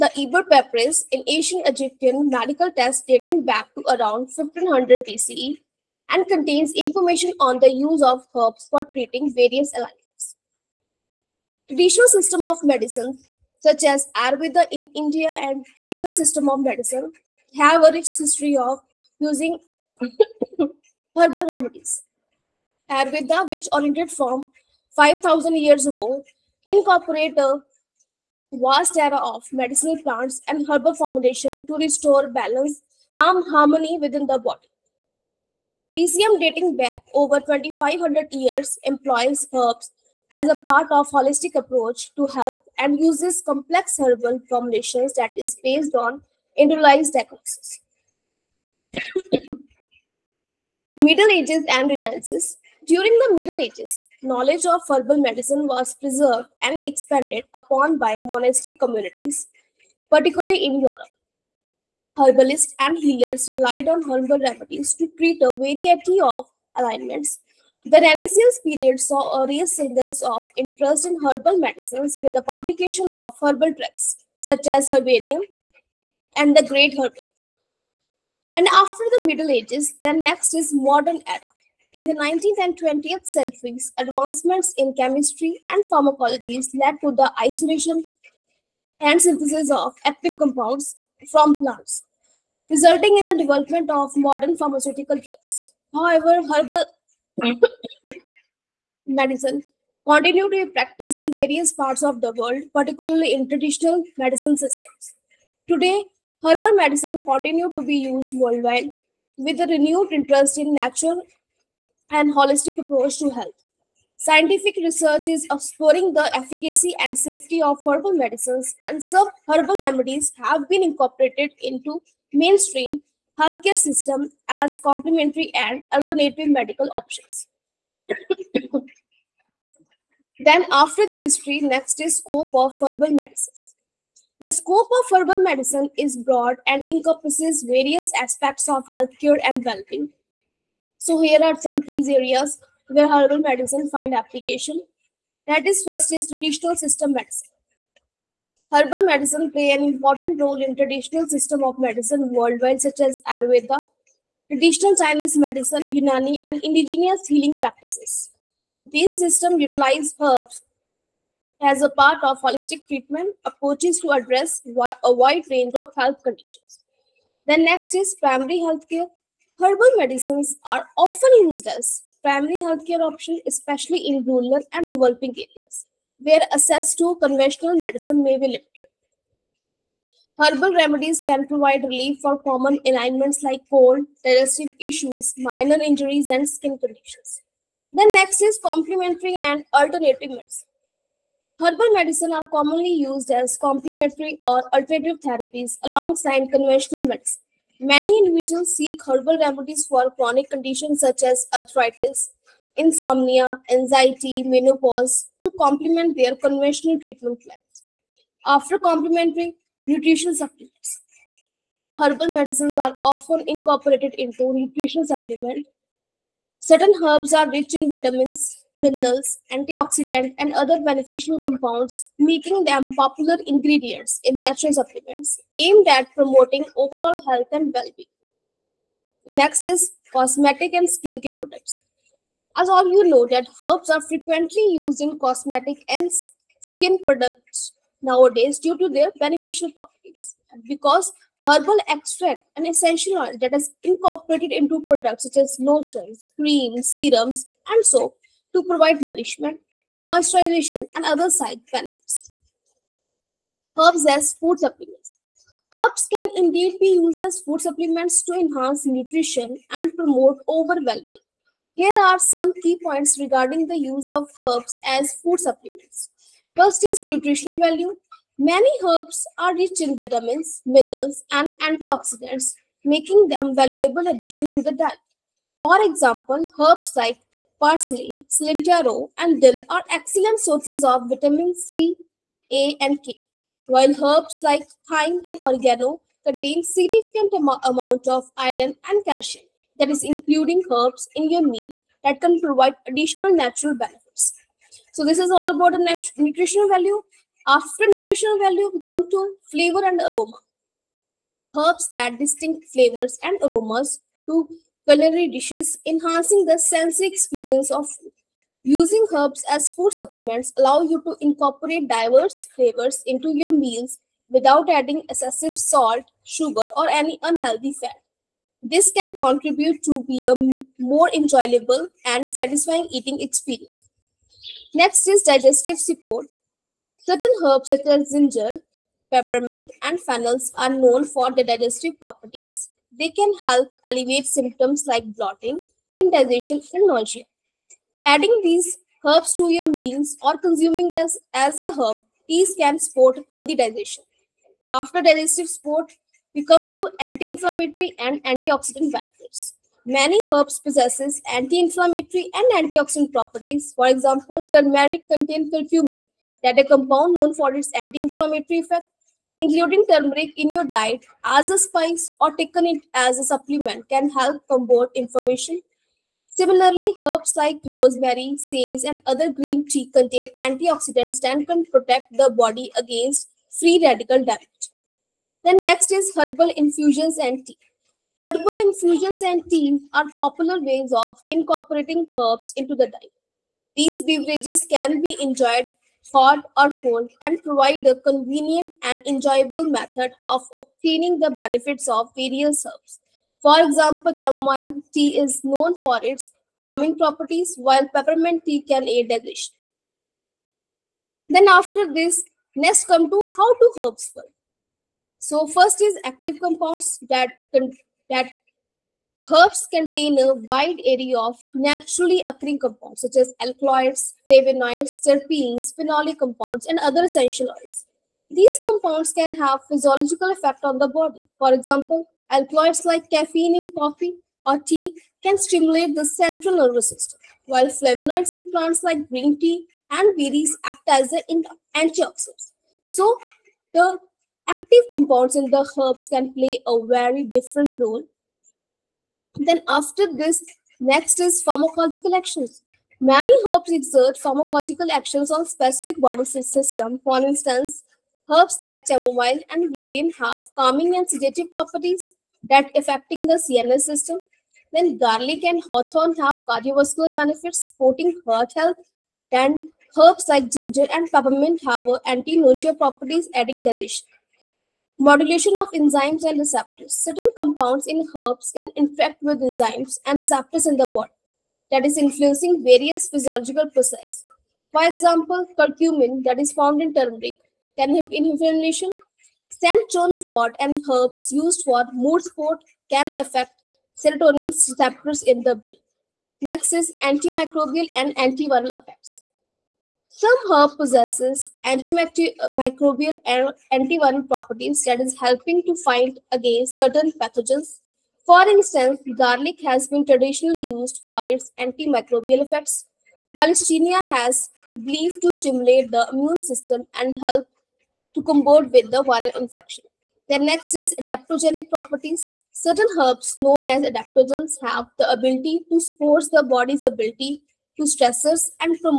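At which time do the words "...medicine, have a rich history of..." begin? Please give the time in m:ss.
0:16.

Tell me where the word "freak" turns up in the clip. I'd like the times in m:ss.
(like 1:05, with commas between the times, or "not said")
not said.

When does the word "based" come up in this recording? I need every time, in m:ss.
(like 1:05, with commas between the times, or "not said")
0:45.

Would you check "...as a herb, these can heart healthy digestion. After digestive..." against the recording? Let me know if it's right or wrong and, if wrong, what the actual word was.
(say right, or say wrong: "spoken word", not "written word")
wrong: "support", not "heart".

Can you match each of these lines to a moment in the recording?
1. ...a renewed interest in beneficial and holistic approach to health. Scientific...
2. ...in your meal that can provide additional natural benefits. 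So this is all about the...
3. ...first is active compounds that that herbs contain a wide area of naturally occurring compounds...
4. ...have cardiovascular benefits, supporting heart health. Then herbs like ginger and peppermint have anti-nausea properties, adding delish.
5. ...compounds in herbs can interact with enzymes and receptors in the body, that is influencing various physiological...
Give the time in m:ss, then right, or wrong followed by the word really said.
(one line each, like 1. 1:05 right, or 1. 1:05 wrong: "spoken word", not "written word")
1. 1:49 wrong: "natural", not "beneficial"
2. 4:51 right
3. 6:45 right
4. 7:36 right
5. 7:47 right.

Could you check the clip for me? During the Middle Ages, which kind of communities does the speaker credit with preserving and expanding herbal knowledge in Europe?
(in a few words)
monastic communities.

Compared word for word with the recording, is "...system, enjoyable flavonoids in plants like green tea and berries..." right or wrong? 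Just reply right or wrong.
wrong.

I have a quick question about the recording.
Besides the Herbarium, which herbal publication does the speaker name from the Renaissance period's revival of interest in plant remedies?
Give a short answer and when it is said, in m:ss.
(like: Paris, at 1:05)
the Great Herbal, at 1:16.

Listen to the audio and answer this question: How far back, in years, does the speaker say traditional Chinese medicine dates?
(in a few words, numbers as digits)
over 2,500 years.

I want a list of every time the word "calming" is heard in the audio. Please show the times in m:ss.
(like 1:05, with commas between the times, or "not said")
6:36, 7:30.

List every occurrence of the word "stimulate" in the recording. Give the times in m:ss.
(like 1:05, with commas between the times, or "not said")
7:05, 8:25.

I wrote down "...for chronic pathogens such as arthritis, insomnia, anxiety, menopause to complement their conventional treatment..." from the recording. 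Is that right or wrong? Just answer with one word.
wrong.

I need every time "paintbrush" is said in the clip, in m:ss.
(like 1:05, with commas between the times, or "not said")
not said.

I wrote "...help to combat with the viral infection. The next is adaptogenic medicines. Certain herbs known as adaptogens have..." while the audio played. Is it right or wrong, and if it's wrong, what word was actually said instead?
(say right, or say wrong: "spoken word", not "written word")
wrong: "properties", not "medicines".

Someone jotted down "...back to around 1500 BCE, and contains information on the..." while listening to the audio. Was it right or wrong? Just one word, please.
right.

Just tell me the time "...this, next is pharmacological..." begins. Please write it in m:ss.
7:20.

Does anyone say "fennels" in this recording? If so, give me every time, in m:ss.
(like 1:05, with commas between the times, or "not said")
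5:29.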